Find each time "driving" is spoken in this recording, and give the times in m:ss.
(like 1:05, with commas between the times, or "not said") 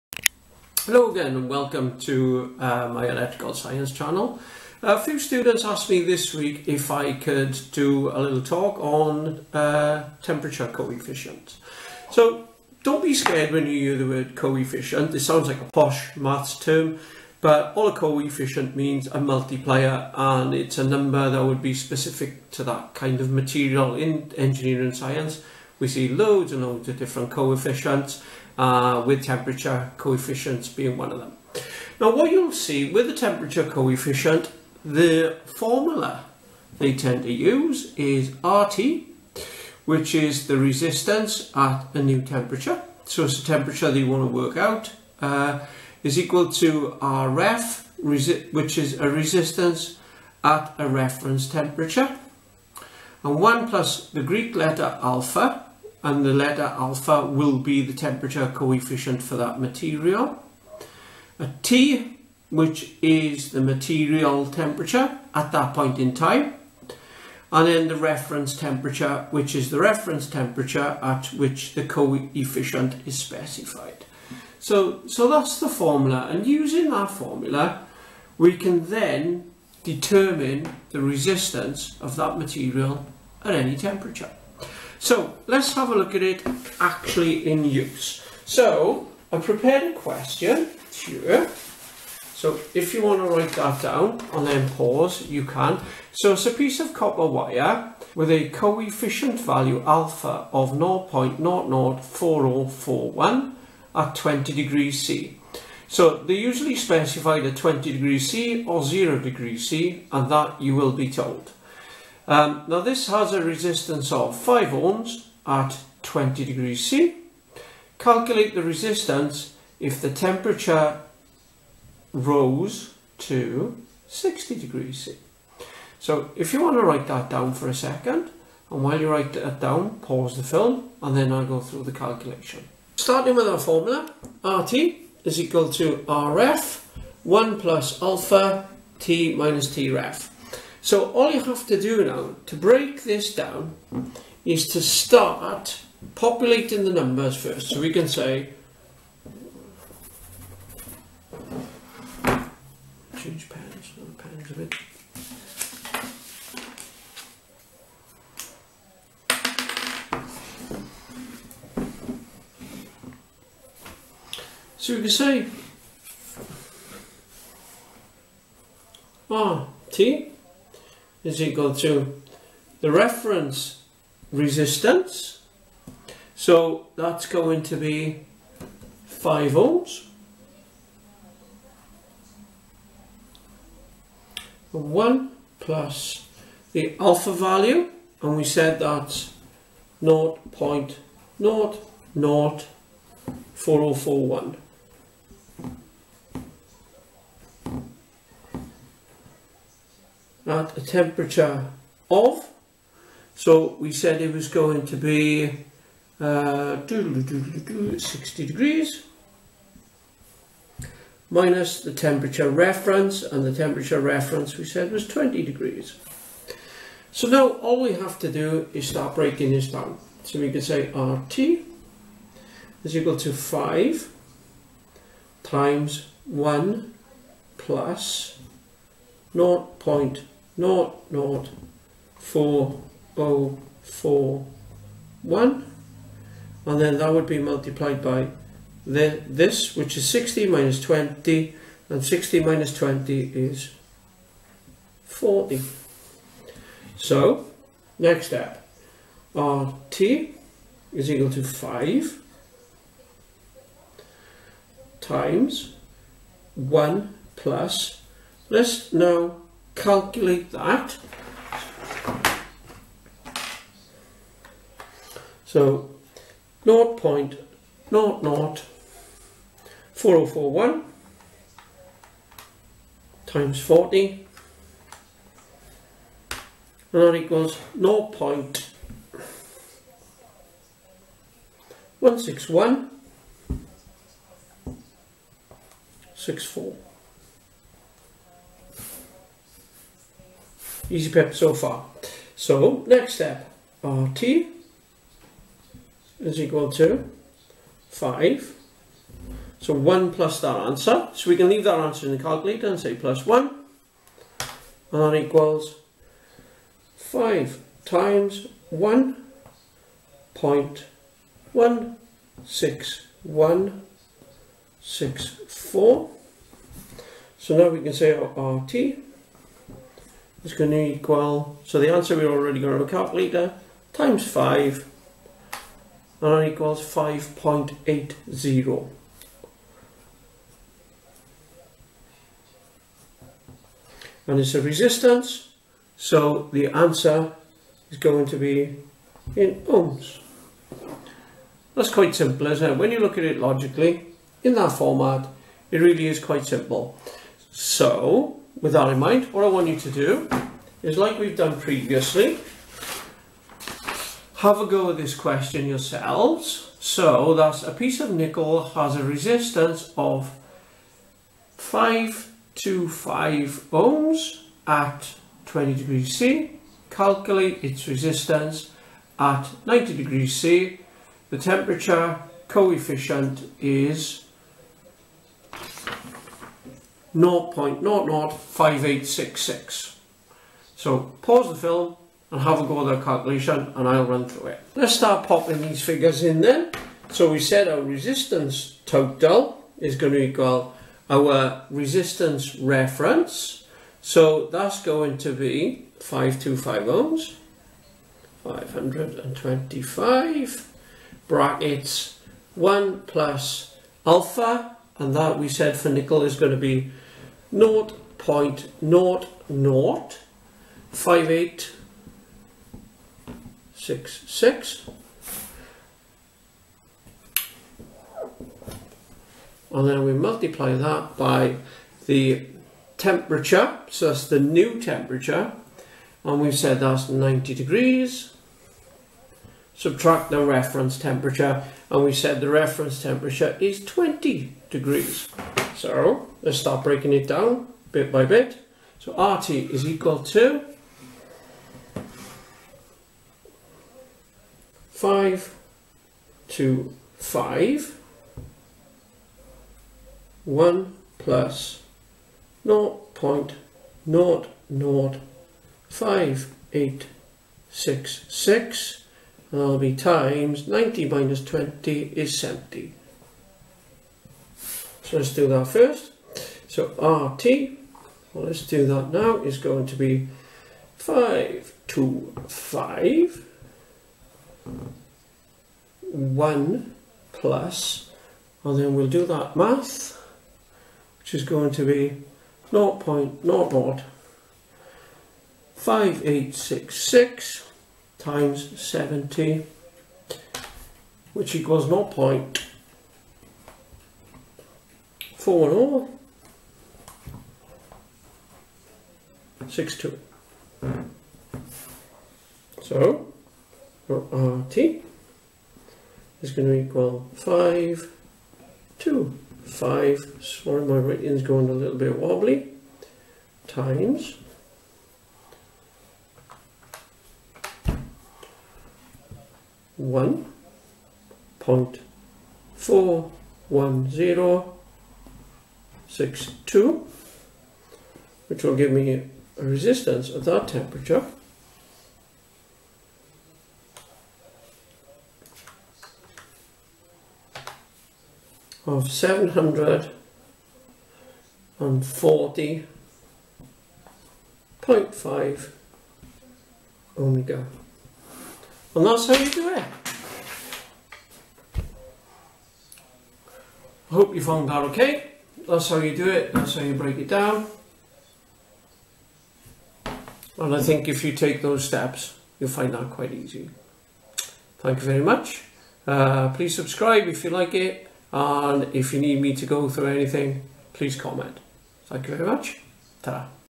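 not said.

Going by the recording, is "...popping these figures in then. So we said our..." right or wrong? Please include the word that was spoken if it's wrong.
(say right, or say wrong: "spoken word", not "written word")
right.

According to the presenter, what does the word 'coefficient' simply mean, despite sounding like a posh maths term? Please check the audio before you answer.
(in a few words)
a multiplier.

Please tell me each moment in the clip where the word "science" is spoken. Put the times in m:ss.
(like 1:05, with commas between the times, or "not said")
0:03, 0:24.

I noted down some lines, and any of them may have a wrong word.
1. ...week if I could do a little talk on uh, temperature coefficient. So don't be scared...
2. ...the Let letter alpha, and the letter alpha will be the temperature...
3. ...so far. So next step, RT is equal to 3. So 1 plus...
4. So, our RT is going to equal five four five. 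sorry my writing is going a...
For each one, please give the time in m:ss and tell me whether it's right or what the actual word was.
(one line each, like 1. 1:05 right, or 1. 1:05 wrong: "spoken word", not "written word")
1. 0:06 right
2. 0:54 wrong: "Greek", not "Let"
3. 4:51 wrong: "5", not "3"
4. 8:22 wrong: "two", not "four".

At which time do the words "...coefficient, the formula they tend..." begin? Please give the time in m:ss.
0:33.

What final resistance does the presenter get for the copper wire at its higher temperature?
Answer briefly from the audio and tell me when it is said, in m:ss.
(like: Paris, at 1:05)
5.80 ohms, at 5:26.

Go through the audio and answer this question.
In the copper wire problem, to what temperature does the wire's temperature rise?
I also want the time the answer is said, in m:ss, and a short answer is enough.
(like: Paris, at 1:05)
60 degrees C, at 2:04.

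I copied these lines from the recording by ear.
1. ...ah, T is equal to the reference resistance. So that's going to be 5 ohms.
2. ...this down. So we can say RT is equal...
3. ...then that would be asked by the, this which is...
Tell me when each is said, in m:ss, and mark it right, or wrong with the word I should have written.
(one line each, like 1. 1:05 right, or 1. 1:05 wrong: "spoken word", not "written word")
1. 2:49 right
2. 3:39 right
3. 3:56 wrong: "multiplied", not "asked".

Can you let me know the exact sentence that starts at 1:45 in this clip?
So they usually specify the 20 degrees C or 0 degrees C and that you will be told.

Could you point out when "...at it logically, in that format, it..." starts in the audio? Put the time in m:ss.
5:43.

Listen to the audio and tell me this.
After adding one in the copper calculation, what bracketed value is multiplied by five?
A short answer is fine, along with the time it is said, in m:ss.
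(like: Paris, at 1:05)
1.16164, at 5:08.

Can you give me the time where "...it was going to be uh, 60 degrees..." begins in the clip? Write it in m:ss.
3:24.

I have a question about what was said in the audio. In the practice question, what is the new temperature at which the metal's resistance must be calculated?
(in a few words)
90 degrees C.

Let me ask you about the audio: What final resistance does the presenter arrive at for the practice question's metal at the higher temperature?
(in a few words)
740.5 ohms.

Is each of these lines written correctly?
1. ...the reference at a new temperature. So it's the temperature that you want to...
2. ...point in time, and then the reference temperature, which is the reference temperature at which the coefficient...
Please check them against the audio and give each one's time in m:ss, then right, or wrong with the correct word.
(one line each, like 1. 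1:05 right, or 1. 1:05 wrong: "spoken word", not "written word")
1. 0:40 wrong: "resistance", not "reference"
2. 1:05 right.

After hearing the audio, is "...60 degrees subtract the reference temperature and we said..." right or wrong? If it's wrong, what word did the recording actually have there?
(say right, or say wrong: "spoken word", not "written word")
wrong: "90", not "60".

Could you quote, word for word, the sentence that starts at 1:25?
So let's have a look at it actually in use.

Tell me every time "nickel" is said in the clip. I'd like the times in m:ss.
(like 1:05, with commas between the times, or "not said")
5:58, 6:45.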